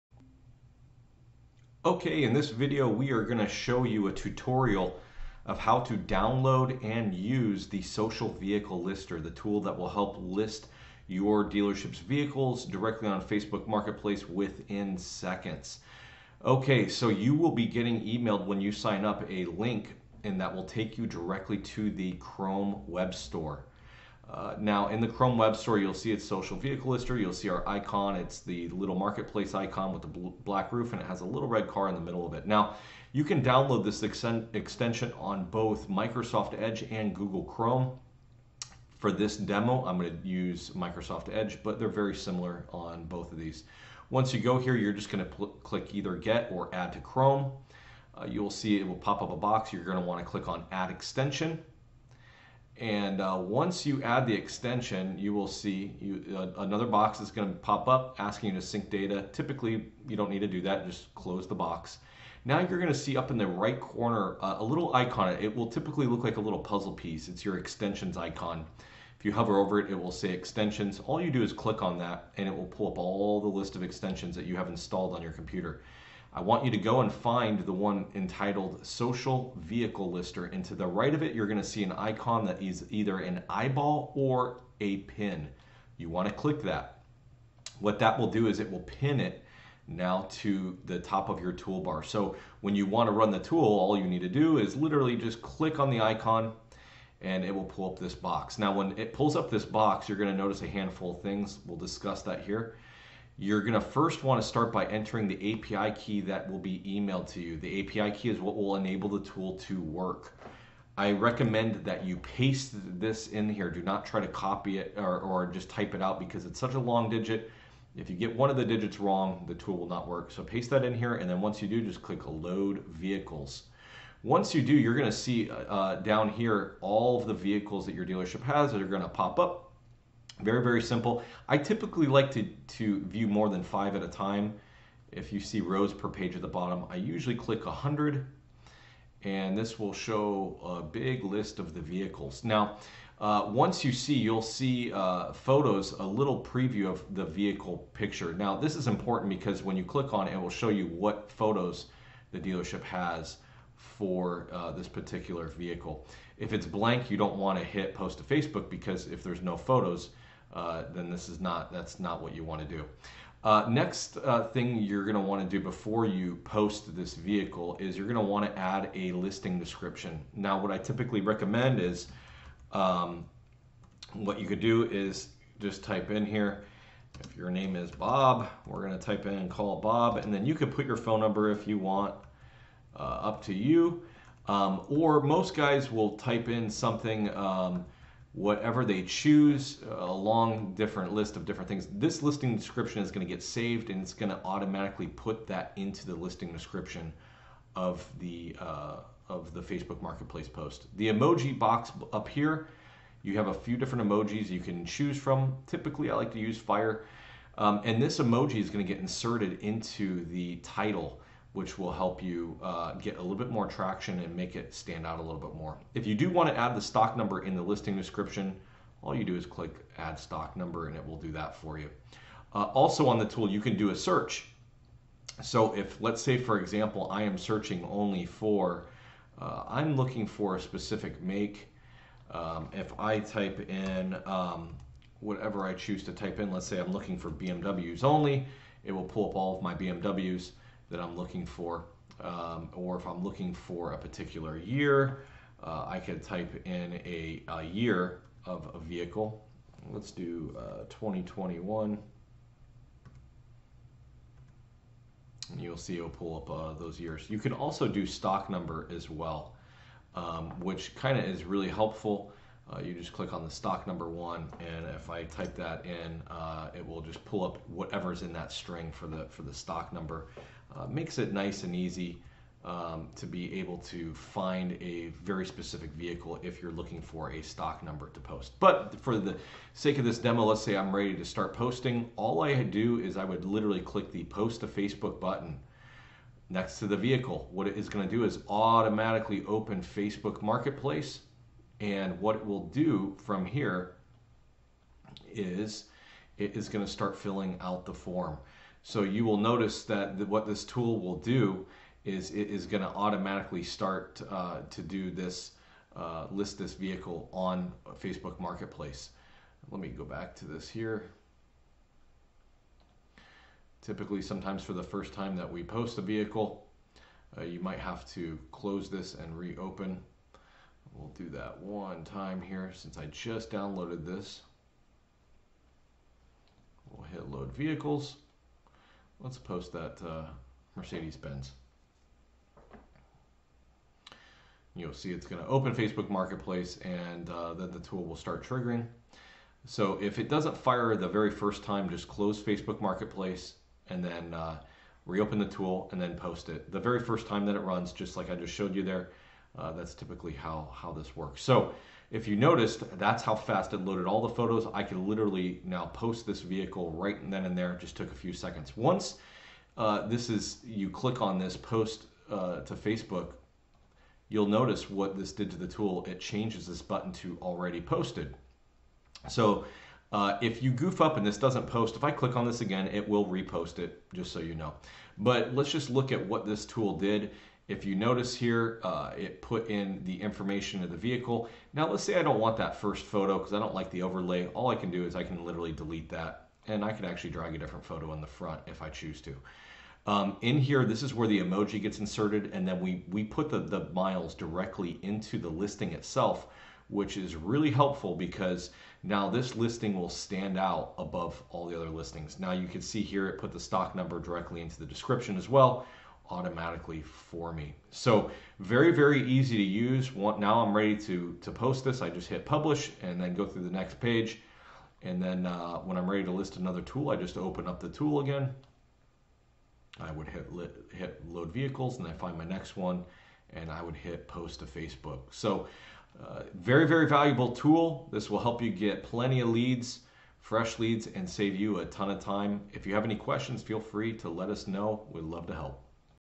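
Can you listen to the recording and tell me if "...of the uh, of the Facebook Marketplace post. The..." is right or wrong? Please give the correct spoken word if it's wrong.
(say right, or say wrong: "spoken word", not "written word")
right.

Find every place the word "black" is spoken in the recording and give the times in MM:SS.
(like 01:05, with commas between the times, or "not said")
00:30.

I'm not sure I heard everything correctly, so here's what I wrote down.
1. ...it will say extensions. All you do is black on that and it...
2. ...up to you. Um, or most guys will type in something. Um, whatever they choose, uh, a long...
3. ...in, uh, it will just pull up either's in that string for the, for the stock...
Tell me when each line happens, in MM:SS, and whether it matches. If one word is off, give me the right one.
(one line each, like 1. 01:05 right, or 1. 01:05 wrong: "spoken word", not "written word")
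1. 01:09 wrong: "click", not "black"
2. 03:02 right
3. 04:25 wrong: "whatever", not "either".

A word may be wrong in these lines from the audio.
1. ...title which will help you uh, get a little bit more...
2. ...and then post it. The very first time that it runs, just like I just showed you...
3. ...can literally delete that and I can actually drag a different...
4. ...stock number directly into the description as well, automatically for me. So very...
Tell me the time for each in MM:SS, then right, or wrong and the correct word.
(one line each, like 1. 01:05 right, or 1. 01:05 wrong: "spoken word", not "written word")
1. 03:30 right
2. 05:45 right
3. 06:25 right
4. 06:43 right.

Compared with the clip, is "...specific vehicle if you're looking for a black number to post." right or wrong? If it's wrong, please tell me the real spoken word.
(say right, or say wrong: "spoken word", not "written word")
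wrong: "stock", not "black".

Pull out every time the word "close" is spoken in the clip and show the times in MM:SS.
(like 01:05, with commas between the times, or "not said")
01:01, 05:18, 05:42.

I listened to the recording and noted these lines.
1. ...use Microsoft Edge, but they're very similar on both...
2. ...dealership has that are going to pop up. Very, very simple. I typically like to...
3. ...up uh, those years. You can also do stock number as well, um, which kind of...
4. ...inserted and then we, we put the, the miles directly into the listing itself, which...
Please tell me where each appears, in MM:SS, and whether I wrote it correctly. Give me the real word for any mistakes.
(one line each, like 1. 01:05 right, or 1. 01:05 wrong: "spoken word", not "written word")
1. 00:40 right
2. 02:08 right
3. 04:16 right
4. 06:31 right.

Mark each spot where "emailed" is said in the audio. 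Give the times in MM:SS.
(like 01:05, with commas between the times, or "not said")
00:18, 01:46.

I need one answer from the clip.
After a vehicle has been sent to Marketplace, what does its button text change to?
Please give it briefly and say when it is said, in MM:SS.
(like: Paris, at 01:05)
already posted, at 06:07.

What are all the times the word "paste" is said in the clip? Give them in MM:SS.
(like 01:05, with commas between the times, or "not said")
01:52, 02:00.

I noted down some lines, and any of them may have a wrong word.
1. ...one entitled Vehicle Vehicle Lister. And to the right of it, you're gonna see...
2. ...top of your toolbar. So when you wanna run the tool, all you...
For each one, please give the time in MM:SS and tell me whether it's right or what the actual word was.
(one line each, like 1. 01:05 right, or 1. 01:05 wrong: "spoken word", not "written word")
1. 01:17 wrong: "Social", not "Vehicle"
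2. 01:30 right.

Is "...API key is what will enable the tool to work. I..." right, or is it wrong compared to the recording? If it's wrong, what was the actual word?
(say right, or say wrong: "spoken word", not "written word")
right.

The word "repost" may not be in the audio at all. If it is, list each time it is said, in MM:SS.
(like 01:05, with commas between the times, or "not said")
06:13.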